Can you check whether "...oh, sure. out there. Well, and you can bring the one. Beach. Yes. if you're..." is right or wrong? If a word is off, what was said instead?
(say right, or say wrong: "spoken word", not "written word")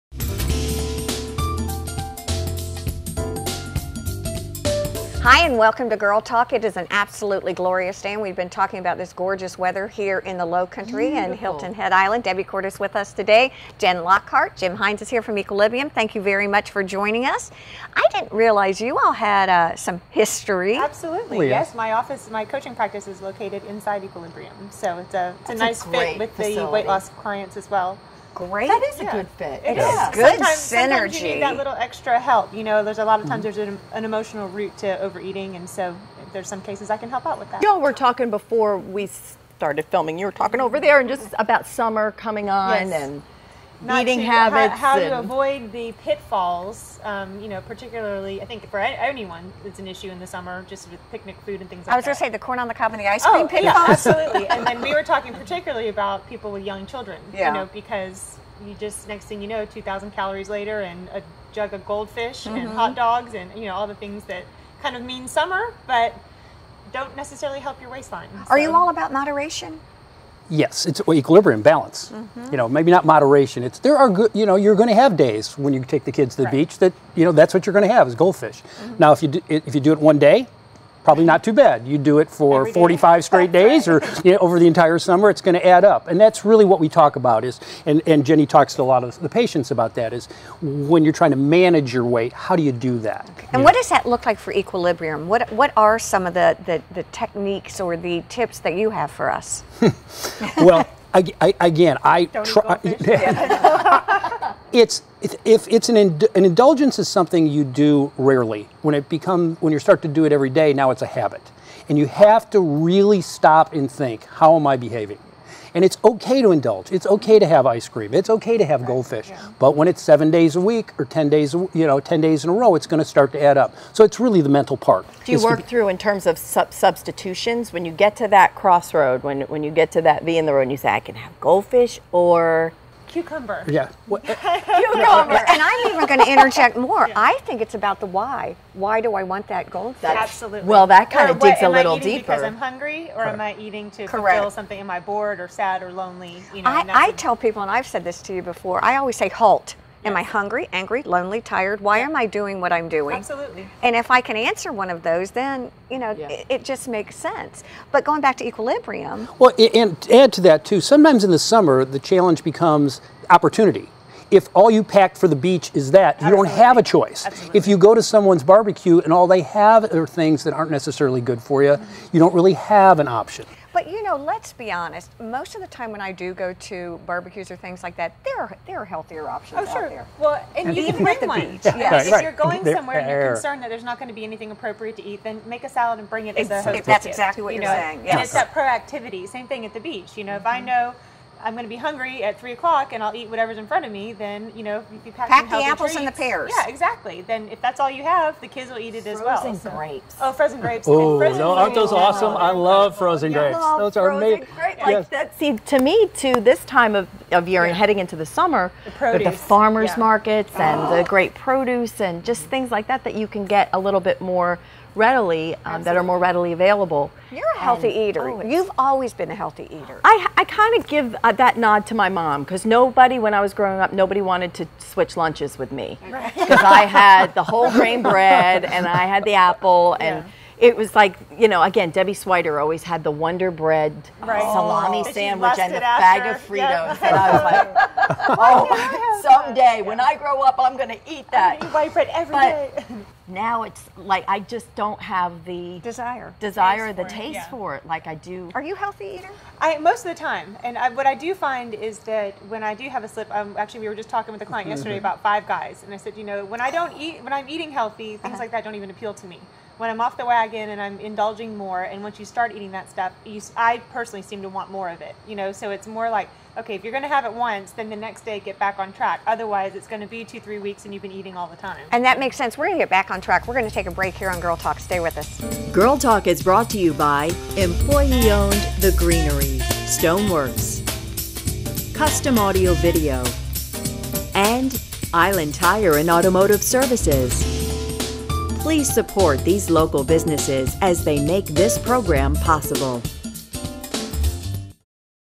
right.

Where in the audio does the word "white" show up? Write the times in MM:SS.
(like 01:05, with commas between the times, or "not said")
04:01.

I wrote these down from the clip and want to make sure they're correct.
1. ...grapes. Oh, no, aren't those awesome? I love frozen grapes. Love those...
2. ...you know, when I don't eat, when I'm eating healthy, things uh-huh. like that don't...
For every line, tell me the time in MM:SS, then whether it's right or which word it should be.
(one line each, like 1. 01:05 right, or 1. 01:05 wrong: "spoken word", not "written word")
1. 03:20 right
2. 04:16 right.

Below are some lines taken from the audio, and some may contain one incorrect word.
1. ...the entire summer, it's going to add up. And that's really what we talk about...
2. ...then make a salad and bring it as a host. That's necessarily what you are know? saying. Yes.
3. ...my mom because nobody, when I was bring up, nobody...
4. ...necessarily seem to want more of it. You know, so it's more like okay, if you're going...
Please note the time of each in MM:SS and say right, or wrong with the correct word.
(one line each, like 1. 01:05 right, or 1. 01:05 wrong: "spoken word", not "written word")
1. 01:24 right
2. 03:05 wrong: "exactly", not "necessarily"
3. 03:41 wrong: "growing", not "bring"
4. 04:23 wrong: "personally", not "necessarily".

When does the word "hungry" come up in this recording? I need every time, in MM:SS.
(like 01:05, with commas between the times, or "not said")
02:22, 02:30, 03:11.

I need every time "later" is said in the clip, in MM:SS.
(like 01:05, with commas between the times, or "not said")
01:00.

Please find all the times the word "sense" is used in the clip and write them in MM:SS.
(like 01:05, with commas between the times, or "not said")
02:37, 04:32.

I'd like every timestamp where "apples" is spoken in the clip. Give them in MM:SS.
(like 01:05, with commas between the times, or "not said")
03:15, 03:49.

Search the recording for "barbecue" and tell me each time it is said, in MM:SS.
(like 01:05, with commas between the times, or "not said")
02:48, 02:57.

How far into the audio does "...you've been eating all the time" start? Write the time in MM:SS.
04:30.